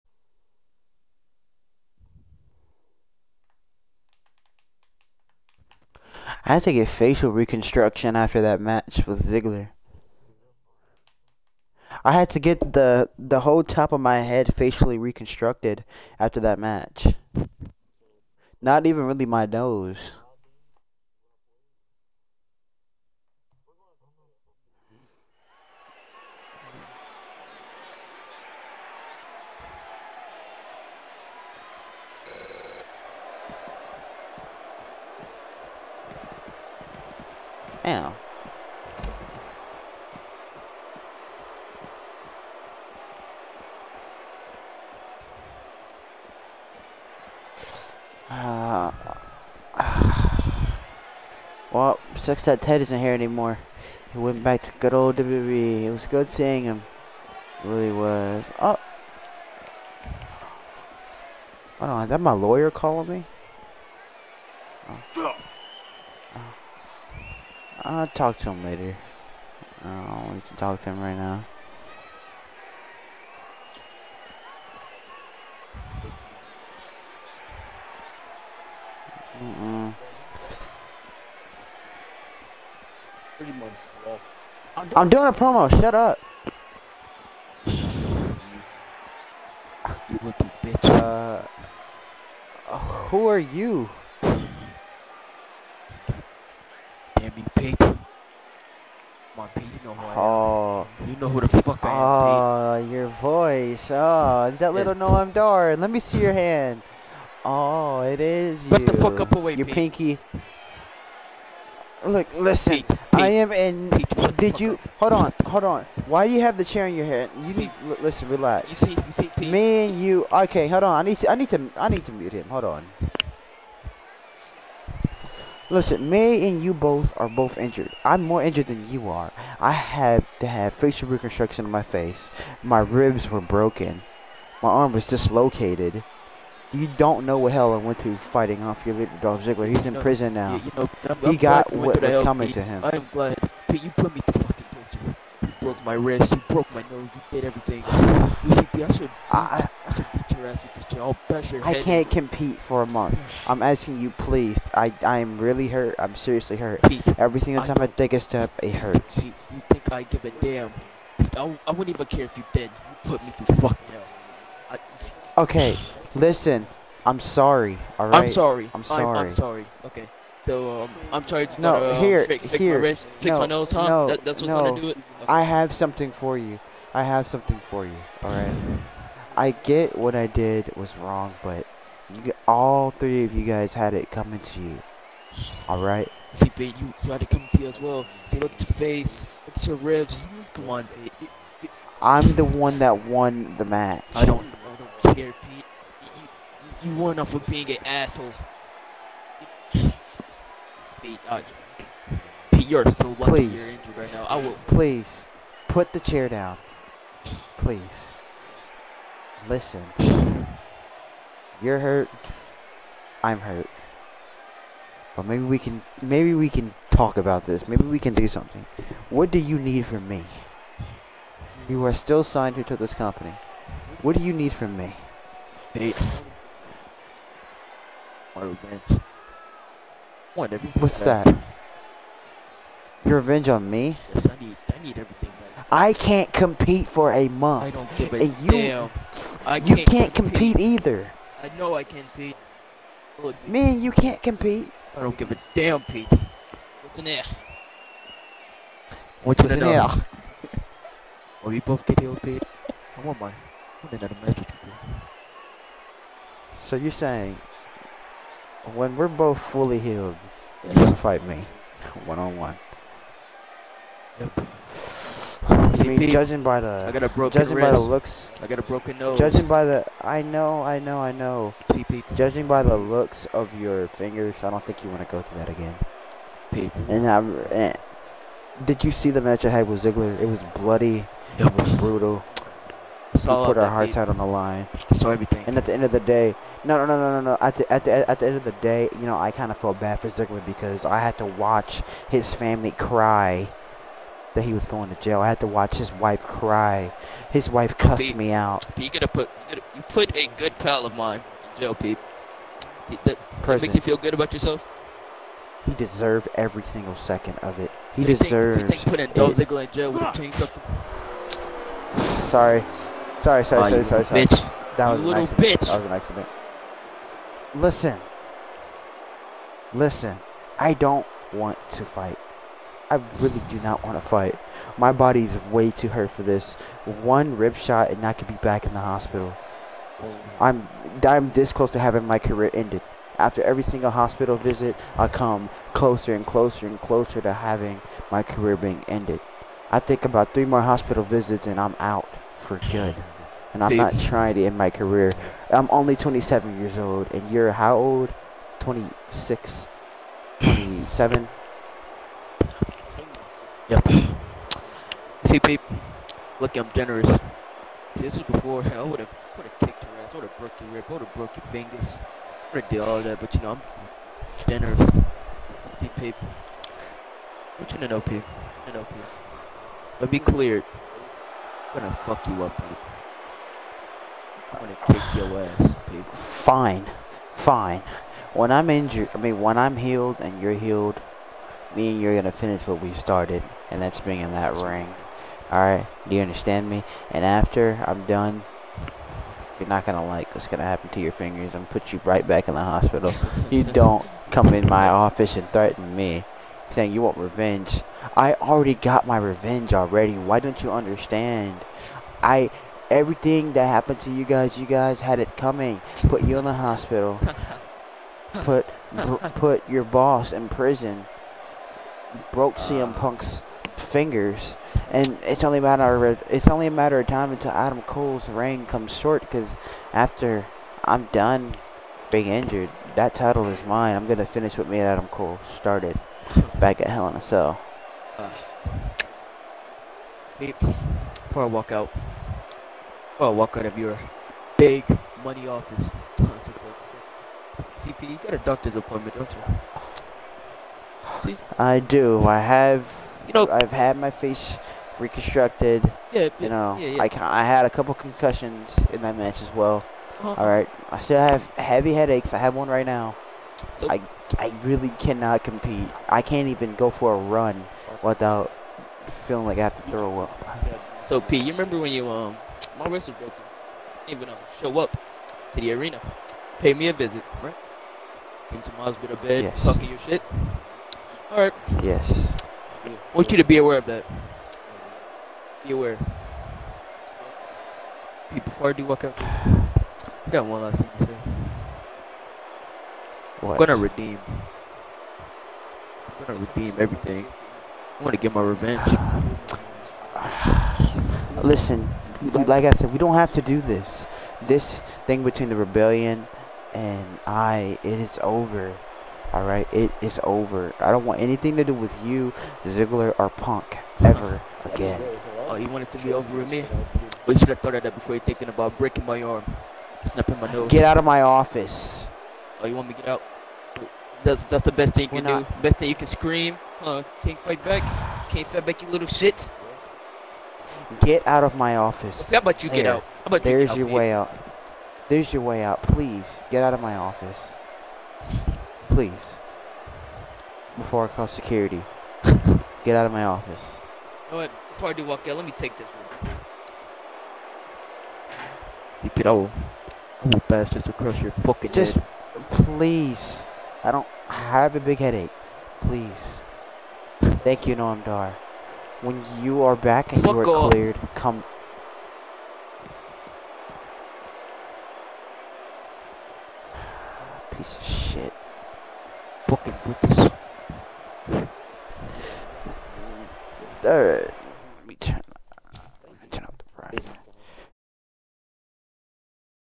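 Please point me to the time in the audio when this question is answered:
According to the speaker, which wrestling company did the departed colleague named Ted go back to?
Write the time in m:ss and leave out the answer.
0:55.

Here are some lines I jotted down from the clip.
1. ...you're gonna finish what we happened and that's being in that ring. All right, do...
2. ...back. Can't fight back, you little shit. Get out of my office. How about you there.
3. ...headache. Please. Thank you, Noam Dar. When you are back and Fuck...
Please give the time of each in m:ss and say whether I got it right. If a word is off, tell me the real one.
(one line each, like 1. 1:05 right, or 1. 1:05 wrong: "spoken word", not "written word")
1. 6:22 wrong: "started", not "happened"
2. 8:37 right
3. 9:04 right.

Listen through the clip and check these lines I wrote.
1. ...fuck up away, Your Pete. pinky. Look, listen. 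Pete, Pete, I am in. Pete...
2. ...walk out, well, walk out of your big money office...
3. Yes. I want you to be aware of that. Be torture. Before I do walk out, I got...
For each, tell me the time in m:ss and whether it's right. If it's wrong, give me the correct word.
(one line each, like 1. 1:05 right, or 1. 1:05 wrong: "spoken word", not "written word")
1. 1:48 right
2. 7:11 right
3. 7:51 wrong: "aware", not "torture".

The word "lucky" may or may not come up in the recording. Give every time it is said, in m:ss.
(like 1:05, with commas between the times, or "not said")
1:30, 3:23.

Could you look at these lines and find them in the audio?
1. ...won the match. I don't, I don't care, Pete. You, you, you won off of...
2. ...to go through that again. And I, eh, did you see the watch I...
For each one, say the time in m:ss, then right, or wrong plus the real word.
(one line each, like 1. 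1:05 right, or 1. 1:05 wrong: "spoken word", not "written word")
1. 3:13 right
2. 4:35 wrong: "match", not "watch".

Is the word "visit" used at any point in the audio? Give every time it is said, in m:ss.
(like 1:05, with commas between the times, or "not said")
5:34, 5:41, 7:46.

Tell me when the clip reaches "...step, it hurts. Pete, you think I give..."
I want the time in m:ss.
2:38.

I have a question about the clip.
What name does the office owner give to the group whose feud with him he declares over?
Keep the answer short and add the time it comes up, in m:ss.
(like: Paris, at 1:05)
the rebellion, at 8:15.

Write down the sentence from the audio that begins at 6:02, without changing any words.
I would have did all that, but you know, I'm generous.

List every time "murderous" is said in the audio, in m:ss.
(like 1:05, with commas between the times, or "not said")
not said.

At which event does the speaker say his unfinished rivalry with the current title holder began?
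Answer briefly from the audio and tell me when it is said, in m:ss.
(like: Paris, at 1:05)
Hell in a Cell, at 7:06.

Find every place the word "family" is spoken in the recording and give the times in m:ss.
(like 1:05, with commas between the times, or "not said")
4:52.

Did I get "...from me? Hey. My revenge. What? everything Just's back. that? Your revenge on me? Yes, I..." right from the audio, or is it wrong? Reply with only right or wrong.
wrong.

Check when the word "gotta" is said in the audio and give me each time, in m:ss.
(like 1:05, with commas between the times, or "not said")
4:58.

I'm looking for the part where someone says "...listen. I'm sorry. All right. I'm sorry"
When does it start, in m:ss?
2:46.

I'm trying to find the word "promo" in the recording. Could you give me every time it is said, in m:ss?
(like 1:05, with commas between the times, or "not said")
1:25.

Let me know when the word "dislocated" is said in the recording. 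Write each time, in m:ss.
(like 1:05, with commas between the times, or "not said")
2:15.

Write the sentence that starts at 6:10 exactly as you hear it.
But be clear, I'm gonna fuck you up, Peep.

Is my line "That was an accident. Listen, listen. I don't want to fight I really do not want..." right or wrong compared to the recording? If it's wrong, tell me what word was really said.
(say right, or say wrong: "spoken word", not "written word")
right.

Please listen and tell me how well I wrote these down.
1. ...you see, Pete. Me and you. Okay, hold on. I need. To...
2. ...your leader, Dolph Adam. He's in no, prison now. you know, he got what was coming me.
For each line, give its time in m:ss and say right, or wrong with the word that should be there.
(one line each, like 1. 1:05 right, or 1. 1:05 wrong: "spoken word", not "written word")
1. 1:58 right
2. 2:18 wrong: "Ziggler", not "Adam".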